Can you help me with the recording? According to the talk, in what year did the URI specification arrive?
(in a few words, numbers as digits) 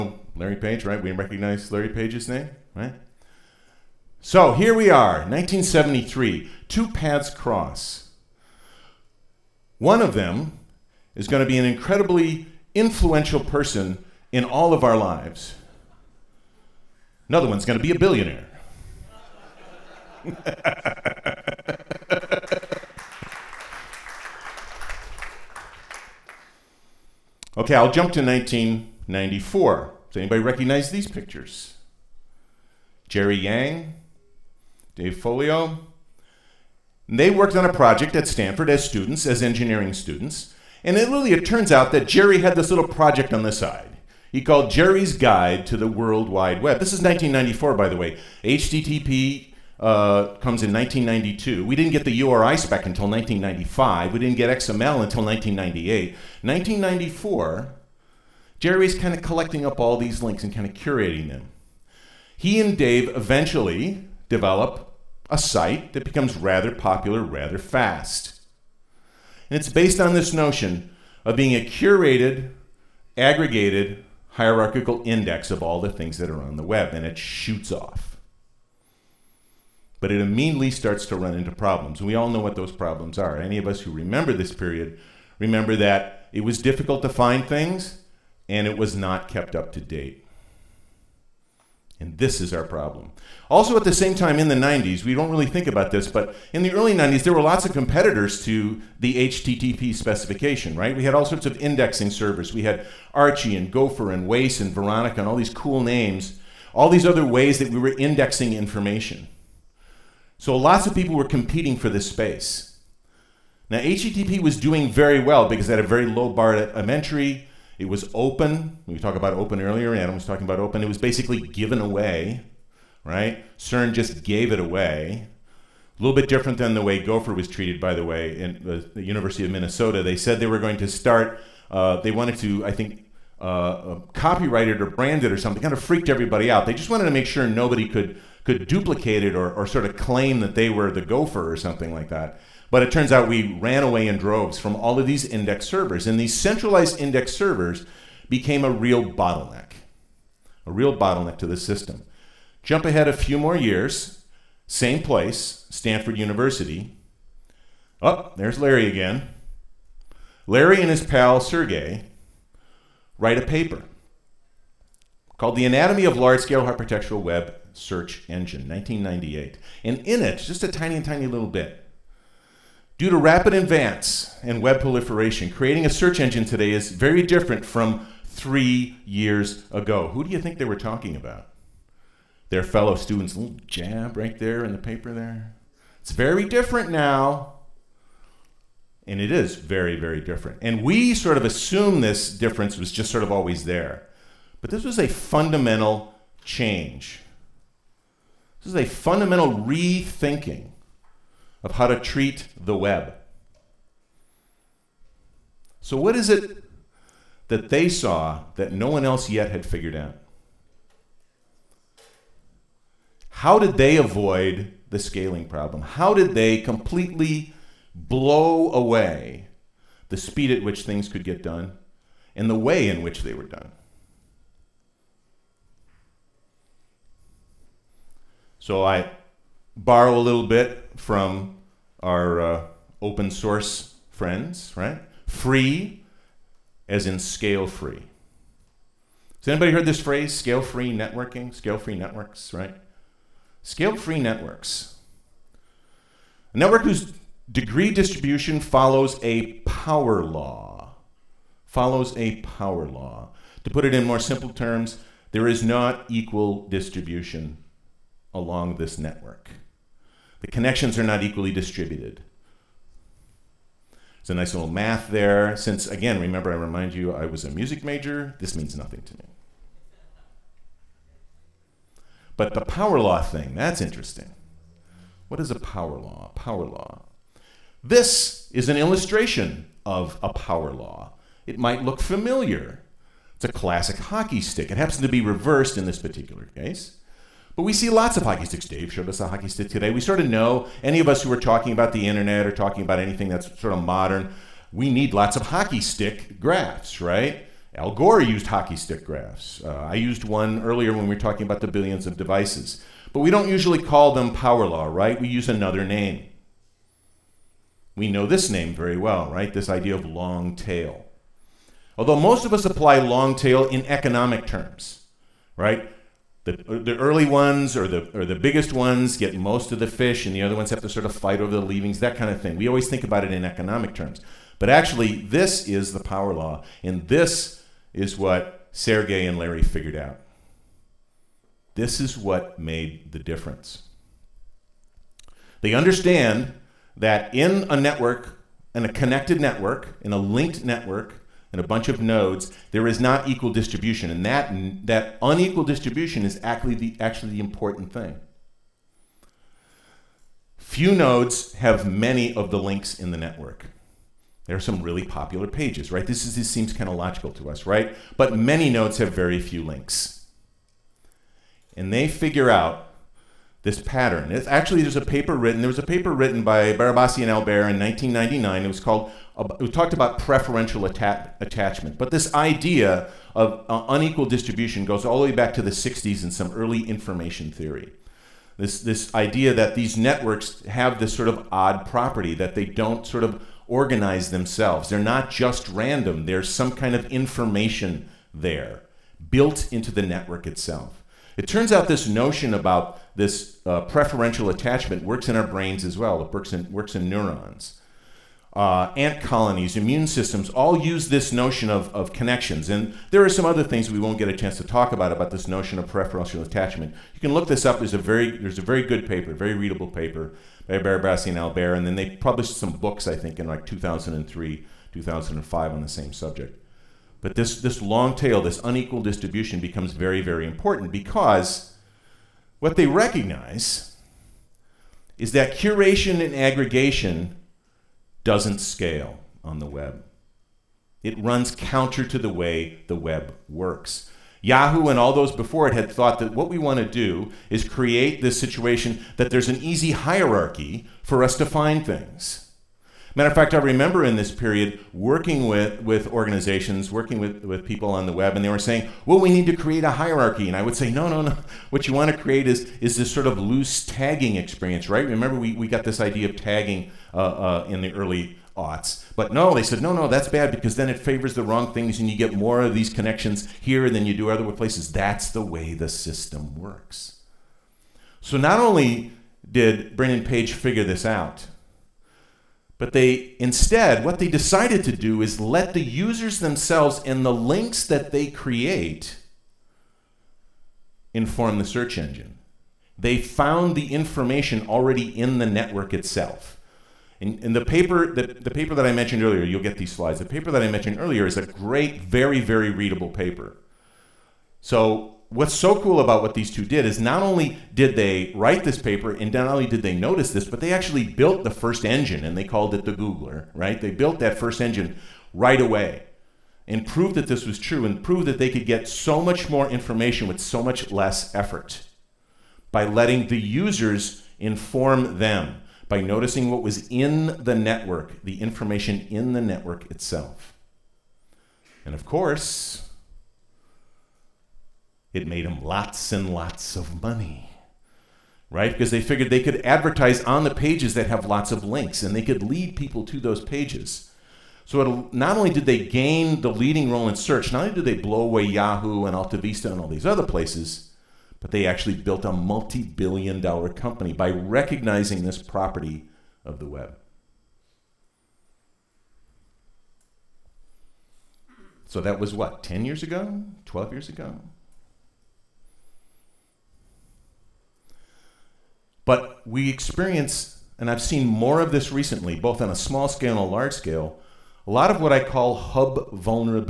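1995.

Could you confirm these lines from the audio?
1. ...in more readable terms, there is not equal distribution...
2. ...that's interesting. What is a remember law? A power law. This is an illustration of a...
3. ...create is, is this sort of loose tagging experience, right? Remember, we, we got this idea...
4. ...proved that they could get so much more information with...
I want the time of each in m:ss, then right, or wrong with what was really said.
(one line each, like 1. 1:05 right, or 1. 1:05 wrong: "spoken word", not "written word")
1. 4:13 wrong: "simple", not "readable"
2. 4:33 wrong: "power", not "remember"
3. 7:32 right
4. 8:28 right.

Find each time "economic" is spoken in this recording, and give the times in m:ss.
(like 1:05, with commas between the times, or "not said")
5:13, 5:23.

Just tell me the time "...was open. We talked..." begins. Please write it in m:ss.
1:57.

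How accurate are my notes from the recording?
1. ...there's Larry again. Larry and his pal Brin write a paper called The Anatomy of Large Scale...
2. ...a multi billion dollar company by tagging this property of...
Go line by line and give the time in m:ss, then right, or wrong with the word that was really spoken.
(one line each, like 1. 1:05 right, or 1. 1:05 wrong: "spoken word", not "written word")
1. 2:38 wrong: "Sergey", not "Brin"
2. 9:02 wrong: "recognizing", not "tagging".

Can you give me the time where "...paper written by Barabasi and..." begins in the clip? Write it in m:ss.
6:05.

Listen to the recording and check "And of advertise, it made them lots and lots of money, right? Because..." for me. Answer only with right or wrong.
wrong.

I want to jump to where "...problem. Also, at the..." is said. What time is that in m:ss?
1:32.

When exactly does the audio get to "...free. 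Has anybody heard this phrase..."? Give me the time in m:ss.
3:57.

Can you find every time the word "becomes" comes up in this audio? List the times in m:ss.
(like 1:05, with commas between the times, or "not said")
1:06, 6:59.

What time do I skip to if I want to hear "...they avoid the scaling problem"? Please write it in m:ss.
3:33.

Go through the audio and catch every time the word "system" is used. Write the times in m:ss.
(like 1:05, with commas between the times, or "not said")
2:31, 6:40, 7:45.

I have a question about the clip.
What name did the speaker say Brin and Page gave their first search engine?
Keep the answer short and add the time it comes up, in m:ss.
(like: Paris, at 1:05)
the Googler, at 8:22.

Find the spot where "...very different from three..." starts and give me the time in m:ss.
2:56.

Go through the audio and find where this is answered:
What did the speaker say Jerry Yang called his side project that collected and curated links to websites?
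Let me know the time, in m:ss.
0:44.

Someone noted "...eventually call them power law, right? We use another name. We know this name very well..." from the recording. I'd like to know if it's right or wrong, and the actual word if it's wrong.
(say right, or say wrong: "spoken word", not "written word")
wrong: "usually", not "eventually".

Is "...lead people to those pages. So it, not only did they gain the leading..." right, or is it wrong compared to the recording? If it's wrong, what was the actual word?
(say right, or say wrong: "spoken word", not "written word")
right.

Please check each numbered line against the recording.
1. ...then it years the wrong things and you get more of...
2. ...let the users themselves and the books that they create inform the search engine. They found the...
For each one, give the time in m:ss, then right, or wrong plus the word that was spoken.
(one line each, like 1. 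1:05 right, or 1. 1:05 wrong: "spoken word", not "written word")
1. 7:40 wrong: "favors", not "years"
2. 7:55 wrong: "links", not "books".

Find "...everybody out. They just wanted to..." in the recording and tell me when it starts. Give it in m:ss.
2:16.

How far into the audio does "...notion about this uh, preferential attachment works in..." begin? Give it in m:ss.
6:32.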